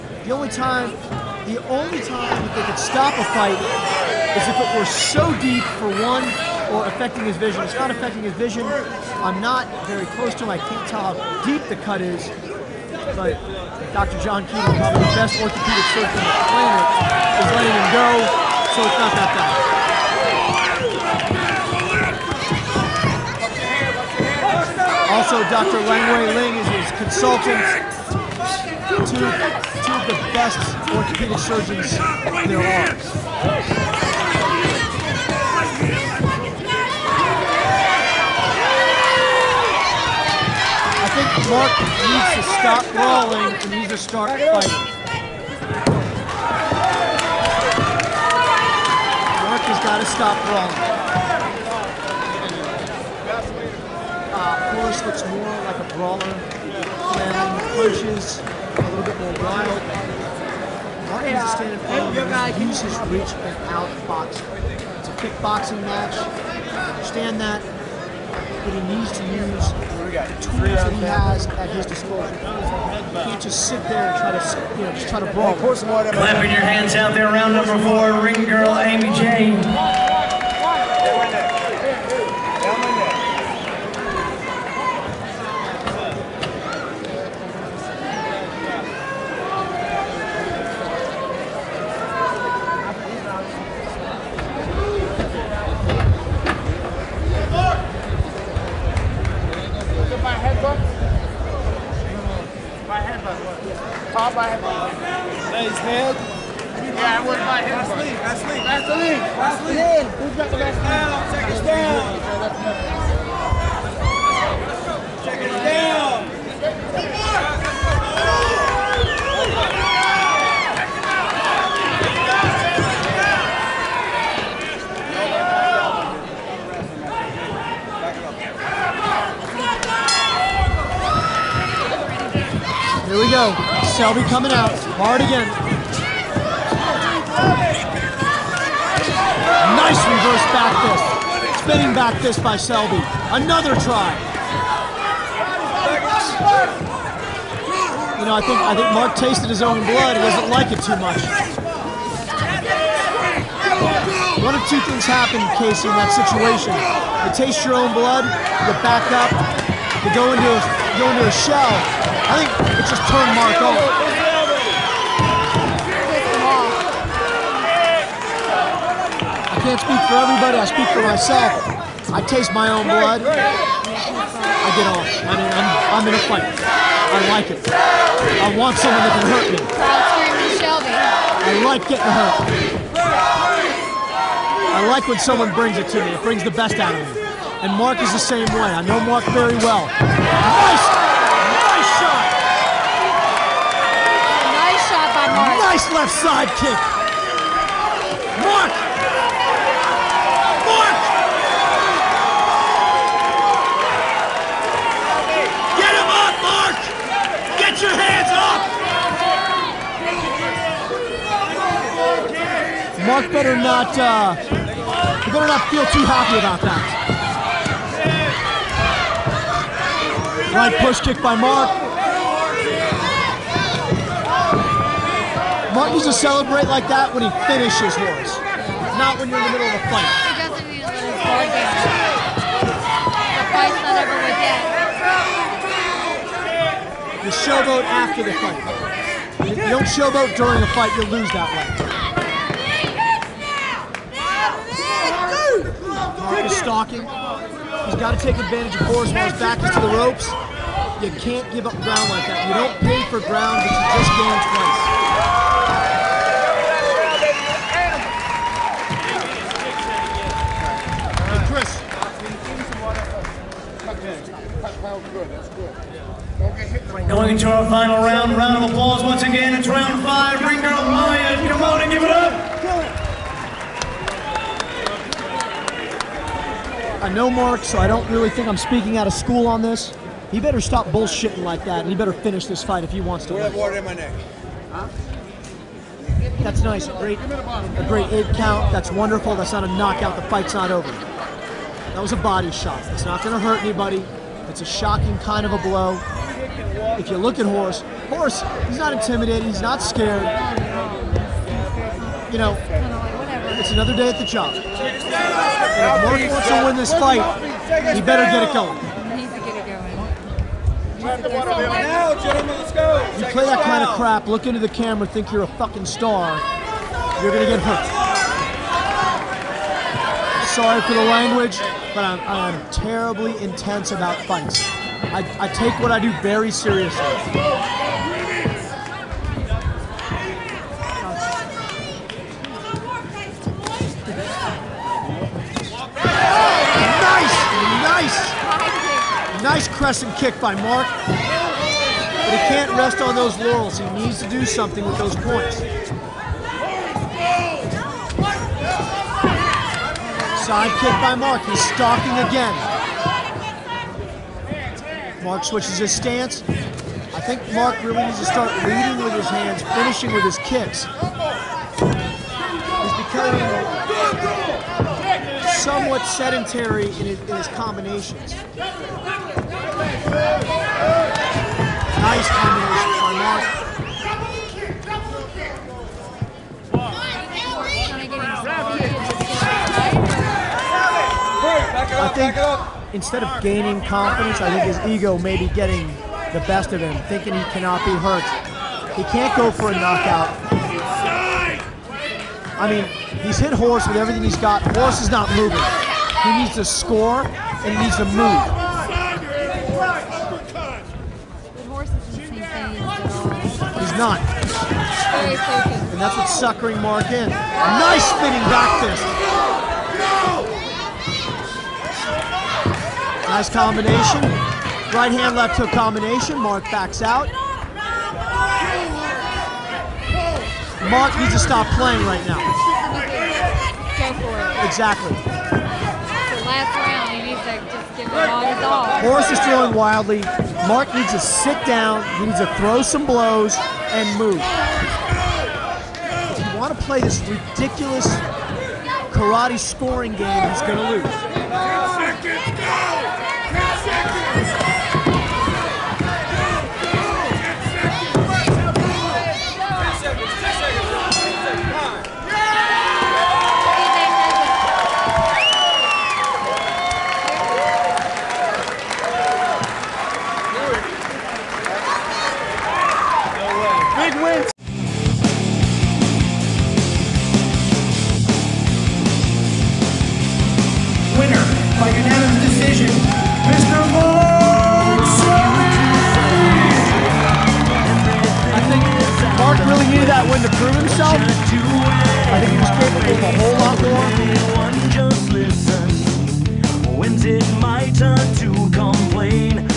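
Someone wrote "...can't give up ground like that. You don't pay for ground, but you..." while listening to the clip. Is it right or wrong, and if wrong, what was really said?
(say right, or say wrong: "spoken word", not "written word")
right.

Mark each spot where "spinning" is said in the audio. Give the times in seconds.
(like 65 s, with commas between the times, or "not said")
141 s, 408 s.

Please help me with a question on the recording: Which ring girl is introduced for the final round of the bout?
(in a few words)
Maya.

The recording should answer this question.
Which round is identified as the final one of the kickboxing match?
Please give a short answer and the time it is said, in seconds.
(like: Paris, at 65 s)
5, at 269 s.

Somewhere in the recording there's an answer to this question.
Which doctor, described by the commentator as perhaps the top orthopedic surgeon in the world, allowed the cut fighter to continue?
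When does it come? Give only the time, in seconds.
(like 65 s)
13 s.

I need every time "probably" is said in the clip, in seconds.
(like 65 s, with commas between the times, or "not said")
14 s.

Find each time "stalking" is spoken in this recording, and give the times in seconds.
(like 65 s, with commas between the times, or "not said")
246 s, 351 s.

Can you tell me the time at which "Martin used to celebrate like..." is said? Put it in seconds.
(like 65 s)
225 s.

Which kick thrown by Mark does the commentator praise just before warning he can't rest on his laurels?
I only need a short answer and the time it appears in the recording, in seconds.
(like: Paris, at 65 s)
Crescent kick, at 339 s.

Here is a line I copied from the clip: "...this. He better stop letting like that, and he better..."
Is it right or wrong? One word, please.
wrong.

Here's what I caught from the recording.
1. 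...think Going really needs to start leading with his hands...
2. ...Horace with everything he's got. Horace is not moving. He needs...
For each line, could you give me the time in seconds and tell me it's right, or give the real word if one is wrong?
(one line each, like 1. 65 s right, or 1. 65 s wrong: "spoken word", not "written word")
1. 357 s wrong: "Mark", not "Going"
2. 393 s right.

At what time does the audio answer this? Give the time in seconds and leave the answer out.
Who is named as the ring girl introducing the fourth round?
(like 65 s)
78 s.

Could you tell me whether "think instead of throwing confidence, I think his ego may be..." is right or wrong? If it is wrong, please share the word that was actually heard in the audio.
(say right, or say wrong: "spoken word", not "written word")
wrong: "gaining", not "throwing".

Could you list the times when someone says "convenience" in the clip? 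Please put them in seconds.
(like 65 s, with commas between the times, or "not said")
not said.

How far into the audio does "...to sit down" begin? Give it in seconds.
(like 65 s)
431 s.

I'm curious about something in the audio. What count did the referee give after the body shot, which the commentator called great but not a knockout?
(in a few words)
8.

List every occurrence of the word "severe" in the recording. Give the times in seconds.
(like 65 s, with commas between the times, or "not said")
not said.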